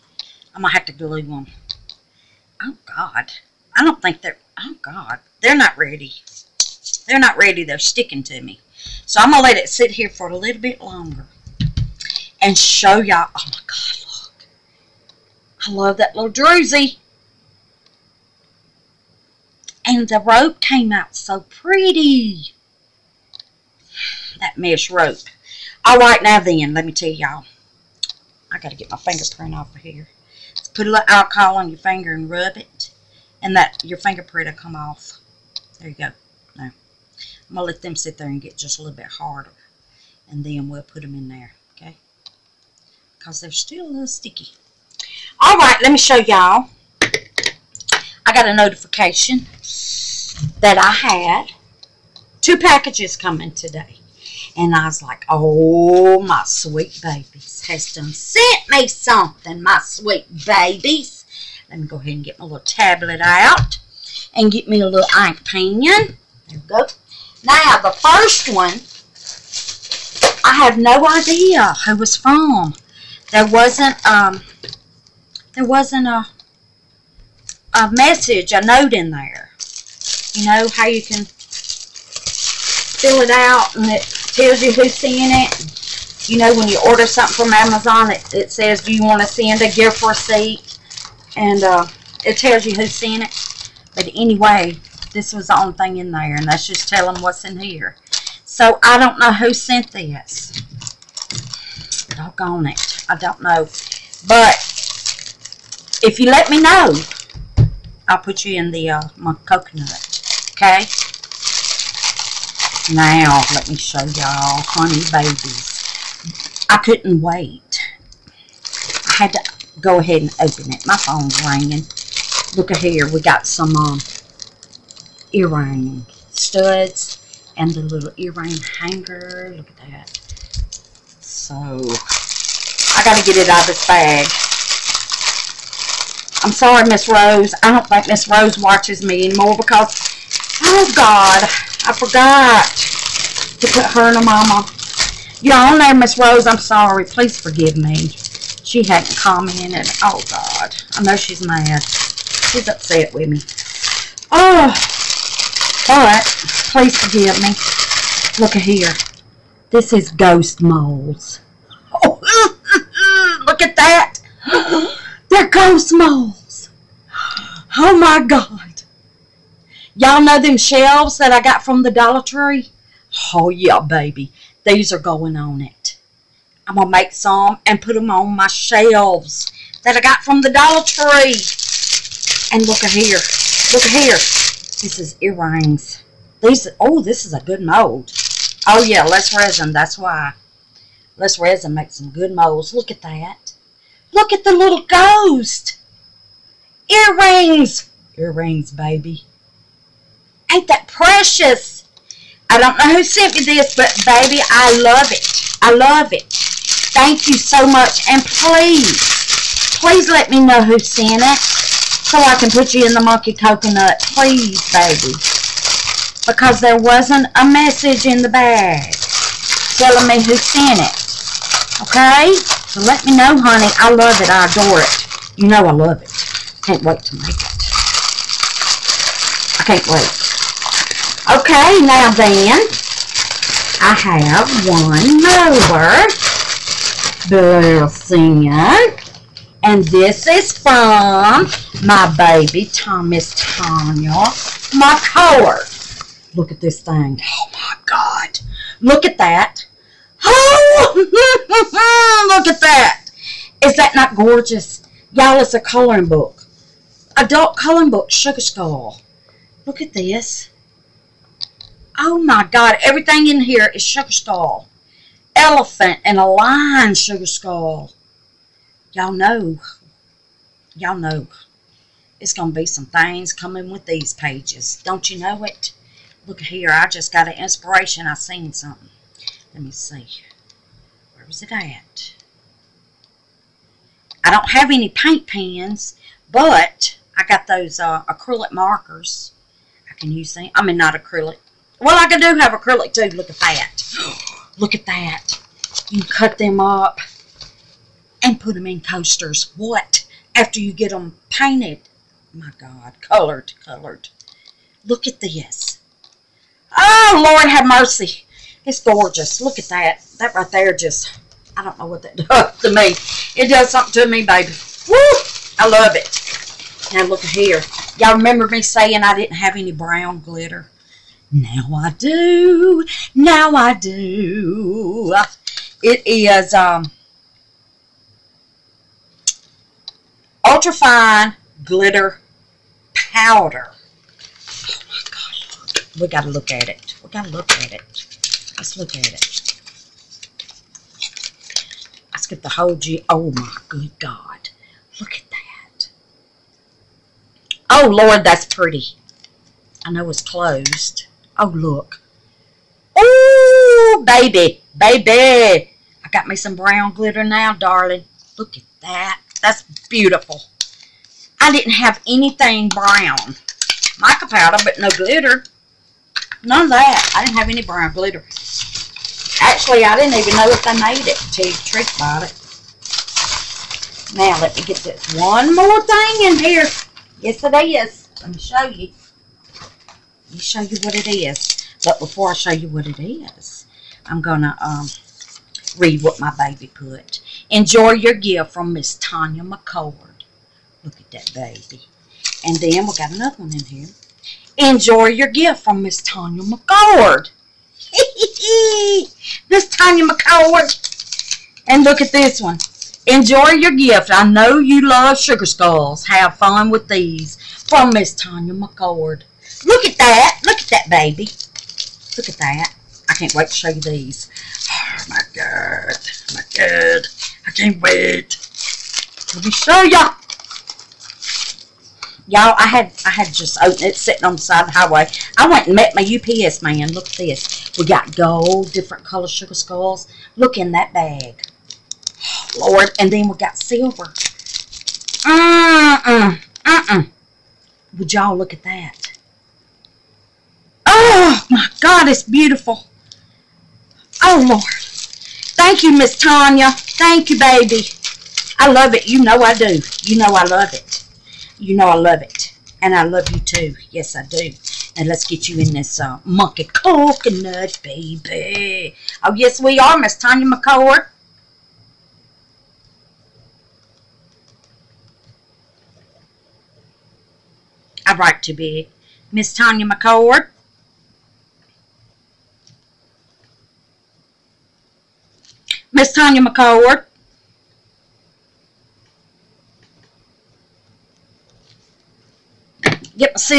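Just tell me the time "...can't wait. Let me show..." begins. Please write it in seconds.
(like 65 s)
417 s.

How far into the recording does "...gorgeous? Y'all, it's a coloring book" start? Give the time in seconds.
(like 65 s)
254 s.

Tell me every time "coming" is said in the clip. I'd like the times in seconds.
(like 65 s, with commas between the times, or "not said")
53 s, 273 s.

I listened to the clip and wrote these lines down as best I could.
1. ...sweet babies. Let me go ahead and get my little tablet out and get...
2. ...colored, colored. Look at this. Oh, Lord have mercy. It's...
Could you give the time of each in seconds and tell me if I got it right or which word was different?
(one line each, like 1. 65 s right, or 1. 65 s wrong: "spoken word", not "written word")
1. 59 s right
2. 303 s right.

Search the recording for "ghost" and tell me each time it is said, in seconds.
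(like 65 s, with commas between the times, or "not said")
160 s, 165 s, 194 s.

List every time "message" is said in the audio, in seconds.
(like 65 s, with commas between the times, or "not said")
77 s, 217 s.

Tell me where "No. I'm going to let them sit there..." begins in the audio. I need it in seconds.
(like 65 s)
36 s.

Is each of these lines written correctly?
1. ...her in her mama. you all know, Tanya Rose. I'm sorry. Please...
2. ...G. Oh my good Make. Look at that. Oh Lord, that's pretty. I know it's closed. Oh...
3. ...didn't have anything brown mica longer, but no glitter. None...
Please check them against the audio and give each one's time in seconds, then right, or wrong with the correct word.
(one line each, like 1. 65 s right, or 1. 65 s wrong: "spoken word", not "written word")
1. 143 s wrong: "Miss", not "Tanya"
2. 342 s wrong: "God", not "Make"
3. 361 s wrong: "powder", not "longer".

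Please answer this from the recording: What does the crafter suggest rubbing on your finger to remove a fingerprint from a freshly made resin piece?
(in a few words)
alcohol.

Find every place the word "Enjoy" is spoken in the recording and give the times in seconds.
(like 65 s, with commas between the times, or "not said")
387 s, 394 s, 403 s.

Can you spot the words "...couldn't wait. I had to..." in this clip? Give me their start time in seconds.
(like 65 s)
116 s.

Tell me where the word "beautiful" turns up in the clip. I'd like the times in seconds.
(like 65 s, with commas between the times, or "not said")
359 s, 442 s.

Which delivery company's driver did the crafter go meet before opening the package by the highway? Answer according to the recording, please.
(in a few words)
UPS.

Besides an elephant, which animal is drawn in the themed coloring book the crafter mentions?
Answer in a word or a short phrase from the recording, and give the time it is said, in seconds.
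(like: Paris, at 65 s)
lion, at 266 s.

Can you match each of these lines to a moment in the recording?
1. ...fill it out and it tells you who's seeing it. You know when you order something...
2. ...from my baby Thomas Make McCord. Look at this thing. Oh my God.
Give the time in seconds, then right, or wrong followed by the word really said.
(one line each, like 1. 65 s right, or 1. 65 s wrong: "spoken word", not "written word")
1. 81 s right
2. 240 s wrong: "Tanya", not "Make".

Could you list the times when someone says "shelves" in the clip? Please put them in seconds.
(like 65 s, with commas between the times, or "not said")
170 s, 178 s.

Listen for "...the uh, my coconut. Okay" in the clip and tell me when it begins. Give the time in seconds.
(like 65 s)
108 s.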